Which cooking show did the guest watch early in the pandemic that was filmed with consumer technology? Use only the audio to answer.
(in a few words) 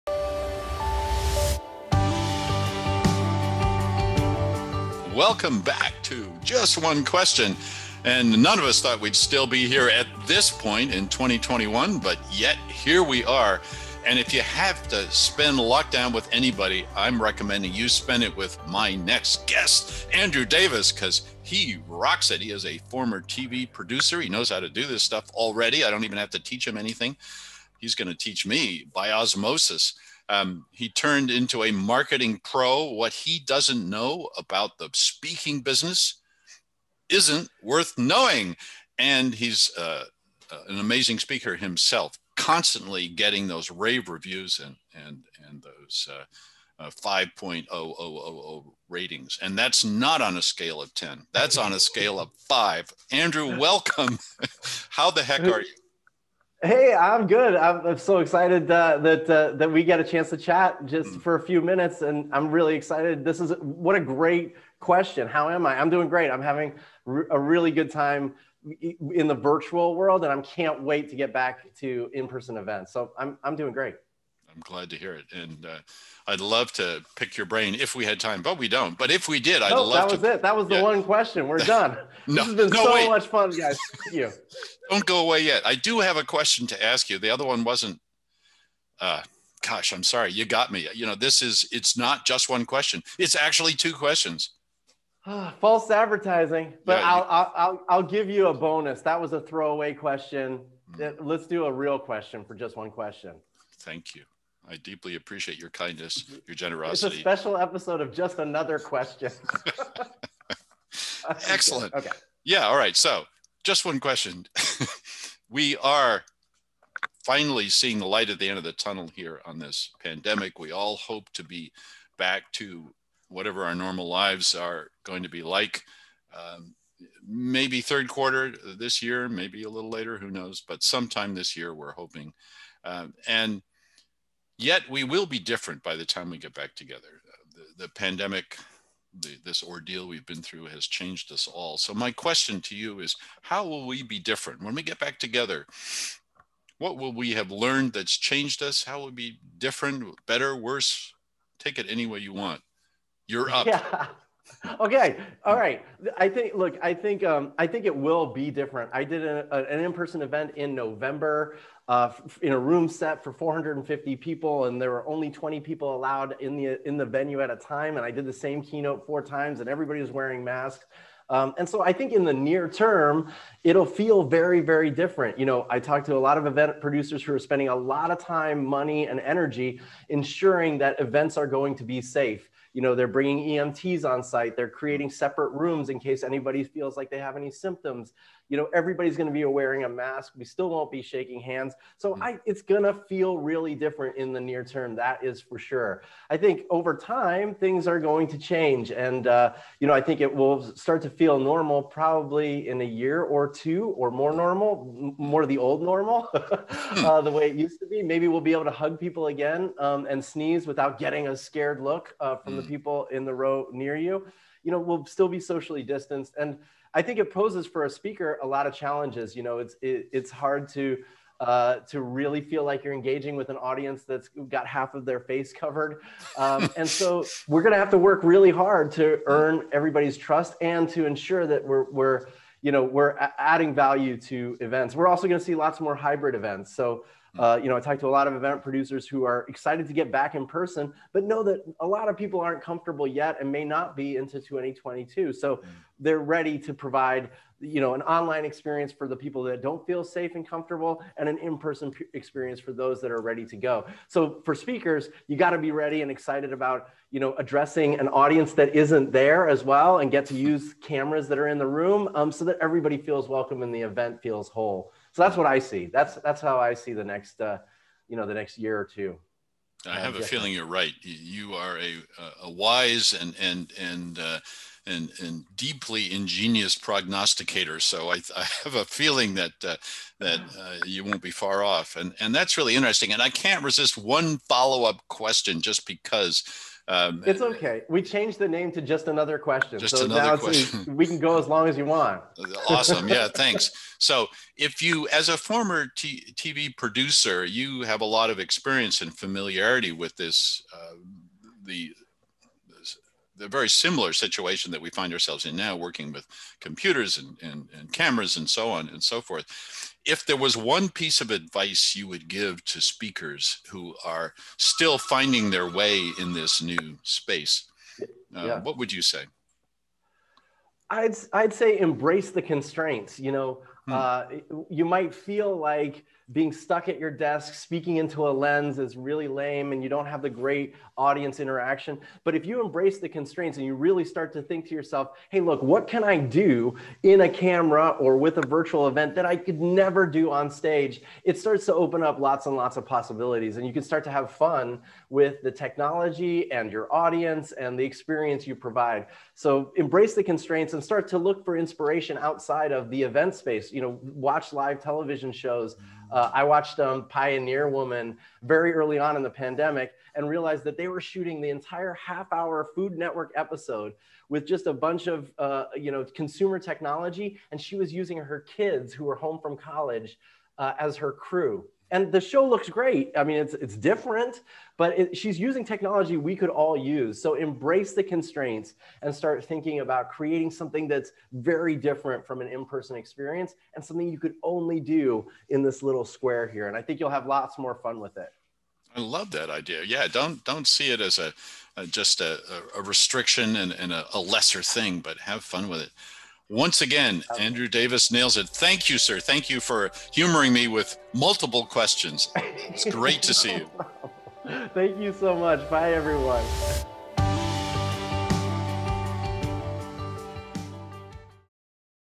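Pioneer Woman.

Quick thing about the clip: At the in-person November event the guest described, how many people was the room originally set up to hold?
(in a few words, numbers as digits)
450.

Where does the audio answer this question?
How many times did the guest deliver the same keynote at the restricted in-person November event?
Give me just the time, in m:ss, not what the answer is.
2:49.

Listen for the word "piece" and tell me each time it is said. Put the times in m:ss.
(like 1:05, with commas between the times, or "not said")
5:10.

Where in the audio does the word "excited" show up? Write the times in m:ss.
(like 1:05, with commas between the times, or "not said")
0:58, 1:02, 3:59, 4:16.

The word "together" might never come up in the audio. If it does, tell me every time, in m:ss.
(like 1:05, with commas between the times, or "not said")
2:16, 2:25.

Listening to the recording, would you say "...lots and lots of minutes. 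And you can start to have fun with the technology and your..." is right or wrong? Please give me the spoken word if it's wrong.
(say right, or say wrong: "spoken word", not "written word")
wrong: "possibilities", not "minutes".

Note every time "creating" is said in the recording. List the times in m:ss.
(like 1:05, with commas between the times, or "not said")
3:04, 6:20.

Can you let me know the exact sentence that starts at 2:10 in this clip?
But sometime this year, we're hoping.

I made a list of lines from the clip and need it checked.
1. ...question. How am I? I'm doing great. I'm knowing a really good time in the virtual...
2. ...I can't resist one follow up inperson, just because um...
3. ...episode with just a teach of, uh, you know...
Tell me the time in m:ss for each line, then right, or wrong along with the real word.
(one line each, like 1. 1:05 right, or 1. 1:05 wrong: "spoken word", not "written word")
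1. 1:04 wrong: "having", not "knowing"
2. 4:43 wrong: "question", not "inperson"
3. 6:03 wrong: "bunch", not "teach".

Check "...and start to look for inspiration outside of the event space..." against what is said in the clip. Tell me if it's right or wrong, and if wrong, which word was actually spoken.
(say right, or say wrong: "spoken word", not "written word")
right.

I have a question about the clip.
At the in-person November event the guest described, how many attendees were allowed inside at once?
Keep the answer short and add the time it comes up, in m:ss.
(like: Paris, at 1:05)
20, at 2:45.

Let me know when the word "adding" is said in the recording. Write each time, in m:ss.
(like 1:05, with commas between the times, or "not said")
3:53.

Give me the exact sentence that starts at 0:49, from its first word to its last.
And that's not on a scale of 10, that's on a scale of five.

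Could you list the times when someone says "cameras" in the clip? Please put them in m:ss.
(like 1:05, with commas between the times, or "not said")
4:20, 5:07, 5:37.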